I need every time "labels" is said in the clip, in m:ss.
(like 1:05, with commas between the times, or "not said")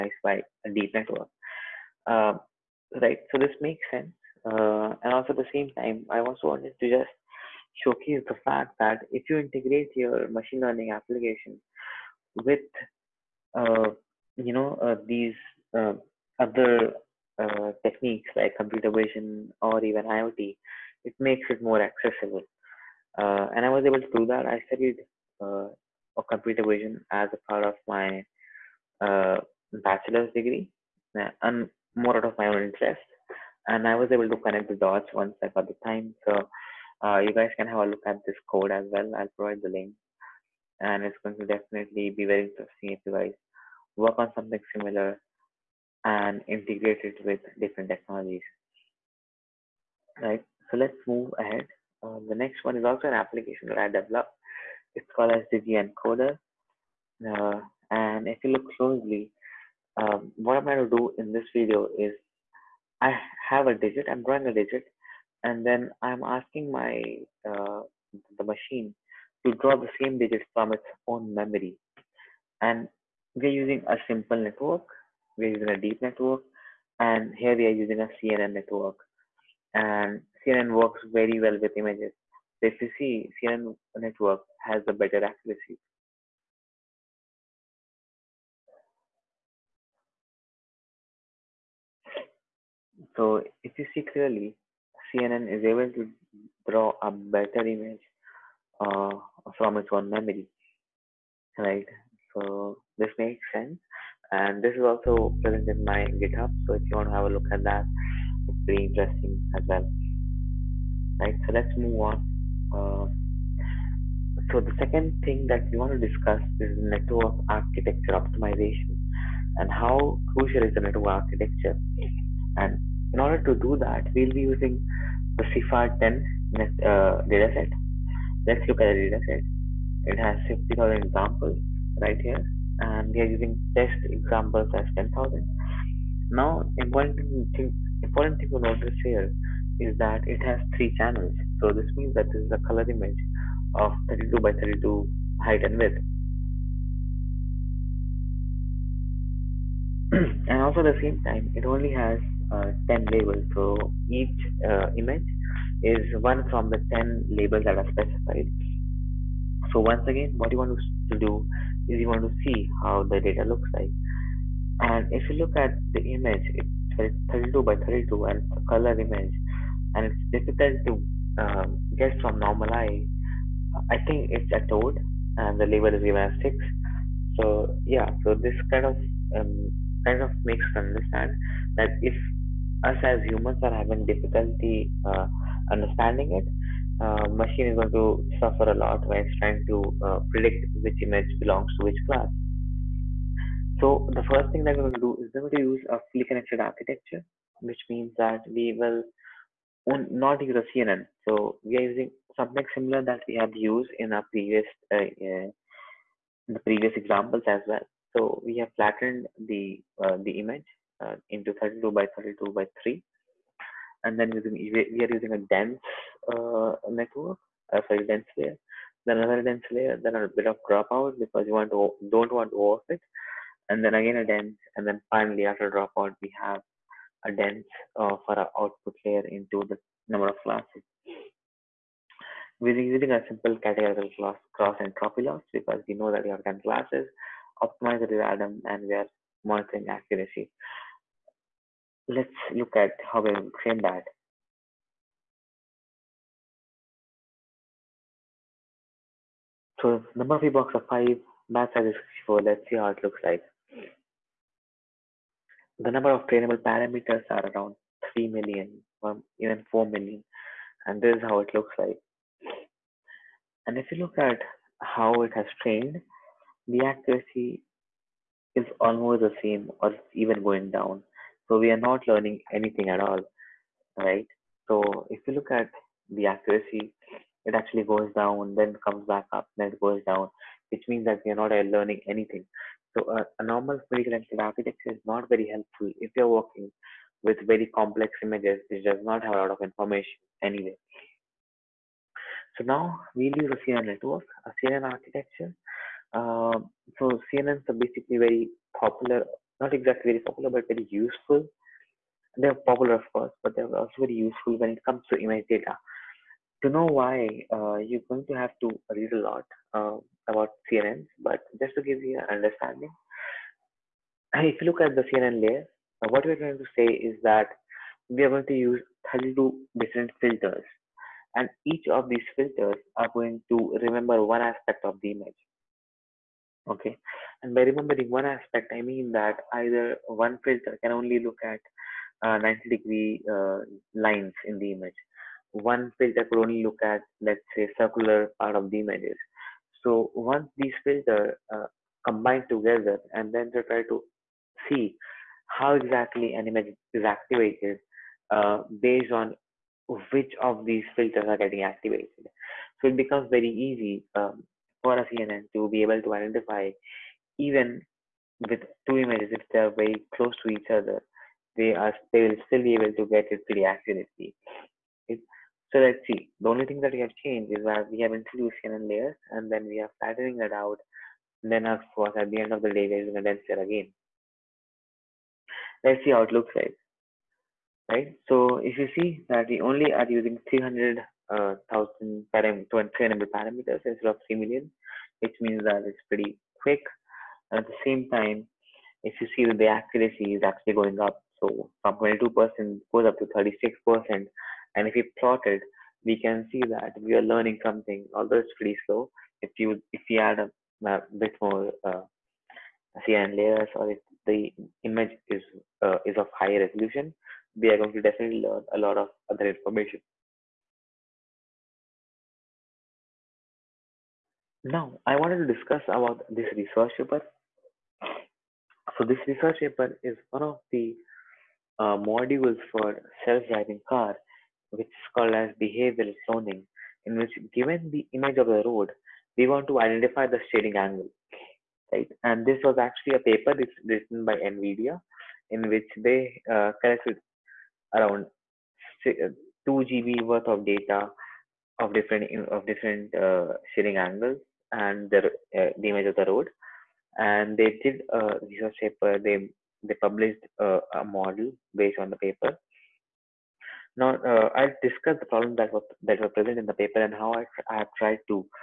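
2:33, 2:37, 2:55.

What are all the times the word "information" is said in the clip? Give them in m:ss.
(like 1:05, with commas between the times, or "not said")
4:49, 6:49.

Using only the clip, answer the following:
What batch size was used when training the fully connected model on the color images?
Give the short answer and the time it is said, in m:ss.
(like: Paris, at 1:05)
64, at 4:12.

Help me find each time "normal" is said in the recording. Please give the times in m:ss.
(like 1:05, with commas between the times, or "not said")
2:52, 4:43.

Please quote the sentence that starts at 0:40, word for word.
And it's going to definitely be very interesting if you guys work on something similar and integrate it with different technologies.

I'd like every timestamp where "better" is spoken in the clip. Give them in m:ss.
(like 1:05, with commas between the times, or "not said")
1:24, 1:37.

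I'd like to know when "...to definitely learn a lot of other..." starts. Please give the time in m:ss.
6:47.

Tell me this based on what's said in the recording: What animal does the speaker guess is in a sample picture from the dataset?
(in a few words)
a toad.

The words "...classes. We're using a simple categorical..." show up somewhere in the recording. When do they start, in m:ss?
3:50.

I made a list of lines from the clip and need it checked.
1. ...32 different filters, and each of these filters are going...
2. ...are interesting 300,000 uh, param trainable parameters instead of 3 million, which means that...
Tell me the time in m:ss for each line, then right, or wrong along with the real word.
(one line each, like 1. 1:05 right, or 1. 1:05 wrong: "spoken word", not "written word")
1. 5:19 right
2. 6:19 wrong: "using", not "interesting".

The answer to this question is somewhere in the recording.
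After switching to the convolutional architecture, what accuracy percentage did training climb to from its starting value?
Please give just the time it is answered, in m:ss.
6:33.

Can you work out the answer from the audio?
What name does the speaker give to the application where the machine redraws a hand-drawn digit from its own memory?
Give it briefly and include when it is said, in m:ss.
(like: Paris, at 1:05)
the encoder, at 0:55.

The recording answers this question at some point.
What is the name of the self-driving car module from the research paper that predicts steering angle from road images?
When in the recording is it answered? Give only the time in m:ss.
7:05.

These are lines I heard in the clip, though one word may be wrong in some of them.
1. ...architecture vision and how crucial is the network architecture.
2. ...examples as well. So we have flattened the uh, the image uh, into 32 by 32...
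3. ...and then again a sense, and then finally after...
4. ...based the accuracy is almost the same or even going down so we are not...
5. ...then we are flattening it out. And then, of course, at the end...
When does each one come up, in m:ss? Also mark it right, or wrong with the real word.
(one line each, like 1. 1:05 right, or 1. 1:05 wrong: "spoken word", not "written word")
1. 1:57 wrong: "optimization", not "vision"
2. 3:26 right
3. 3:43 wrong: "dense", not "sense"
4. 4:25 wrong: "trained", not "based"
5. 6:09 right.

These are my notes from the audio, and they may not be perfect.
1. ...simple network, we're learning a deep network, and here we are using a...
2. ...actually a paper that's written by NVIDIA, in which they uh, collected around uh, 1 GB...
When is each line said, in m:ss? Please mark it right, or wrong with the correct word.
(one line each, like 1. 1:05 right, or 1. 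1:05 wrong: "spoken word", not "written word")
1. 1:14 wrong: "using", not "learning"
2. 7:12 wrong: "2", not "1".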